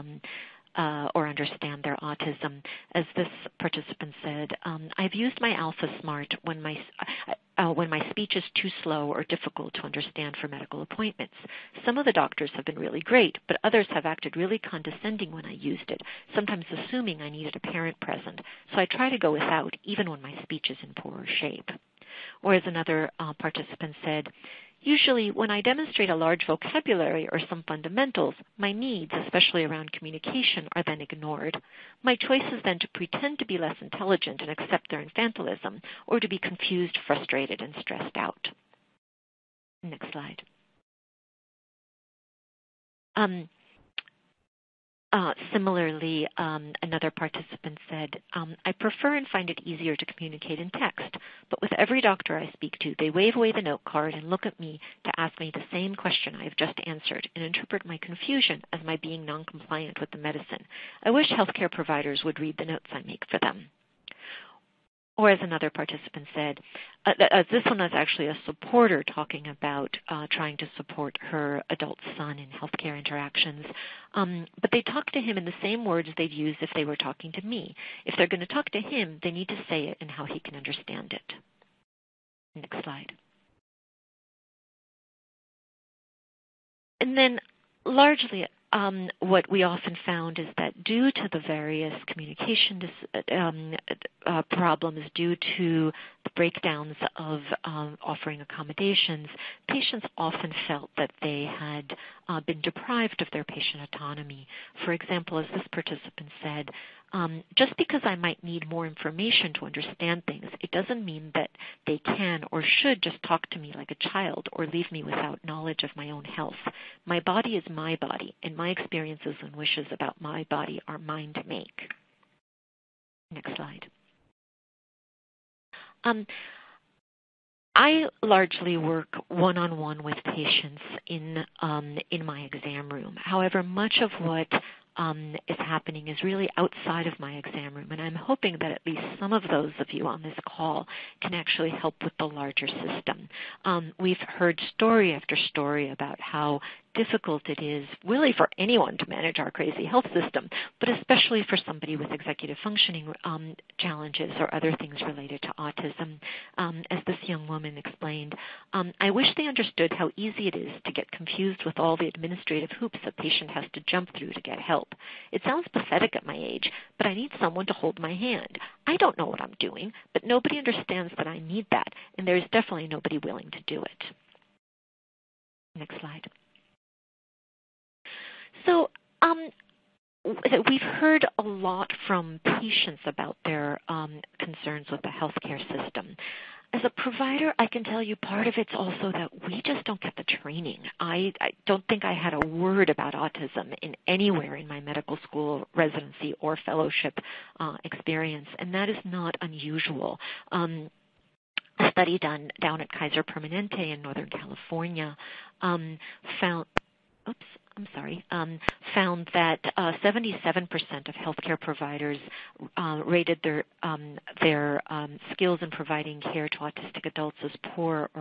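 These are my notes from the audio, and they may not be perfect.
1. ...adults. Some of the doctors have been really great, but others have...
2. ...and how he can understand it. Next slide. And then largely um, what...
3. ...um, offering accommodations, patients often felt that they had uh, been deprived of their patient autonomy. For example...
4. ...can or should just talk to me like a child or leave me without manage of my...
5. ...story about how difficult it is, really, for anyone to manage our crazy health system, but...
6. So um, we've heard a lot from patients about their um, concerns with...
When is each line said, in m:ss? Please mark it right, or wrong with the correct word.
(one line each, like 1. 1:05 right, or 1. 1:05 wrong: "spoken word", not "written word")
1. 0:10 wrong: "appointments", not "adults"
2. 1:20 right
3. 1:37 right
4. 1:51 wrong: "knowledge", not "manage"
5. 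2:25 right
6. 2:58 right.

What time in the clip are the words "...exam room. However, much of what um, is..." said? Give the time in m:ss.
2:12.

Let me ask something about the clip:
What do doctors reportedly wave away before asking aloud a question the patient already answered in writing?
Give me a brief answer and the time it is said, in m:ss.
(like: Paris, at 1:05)
note card, at 0:53.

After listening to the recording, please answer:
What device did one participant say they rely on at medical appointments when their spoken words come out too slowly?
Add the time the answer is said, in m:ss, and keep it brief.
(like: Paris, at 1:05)
Alpha Smart, at 0:05.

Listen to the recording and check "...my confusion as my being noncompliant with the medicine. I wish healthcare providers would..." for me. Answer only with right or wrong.
right.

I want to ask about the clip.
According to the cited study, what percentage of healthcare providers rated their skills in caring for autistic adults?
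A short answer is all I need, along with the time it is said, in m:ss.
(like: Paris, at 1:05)
77%, at 3:29.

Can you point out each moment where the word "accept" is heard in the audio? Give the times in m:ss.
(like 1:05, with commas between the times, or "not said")
0:34.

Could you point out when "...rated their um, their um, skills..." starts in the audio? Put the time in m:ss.
3:33.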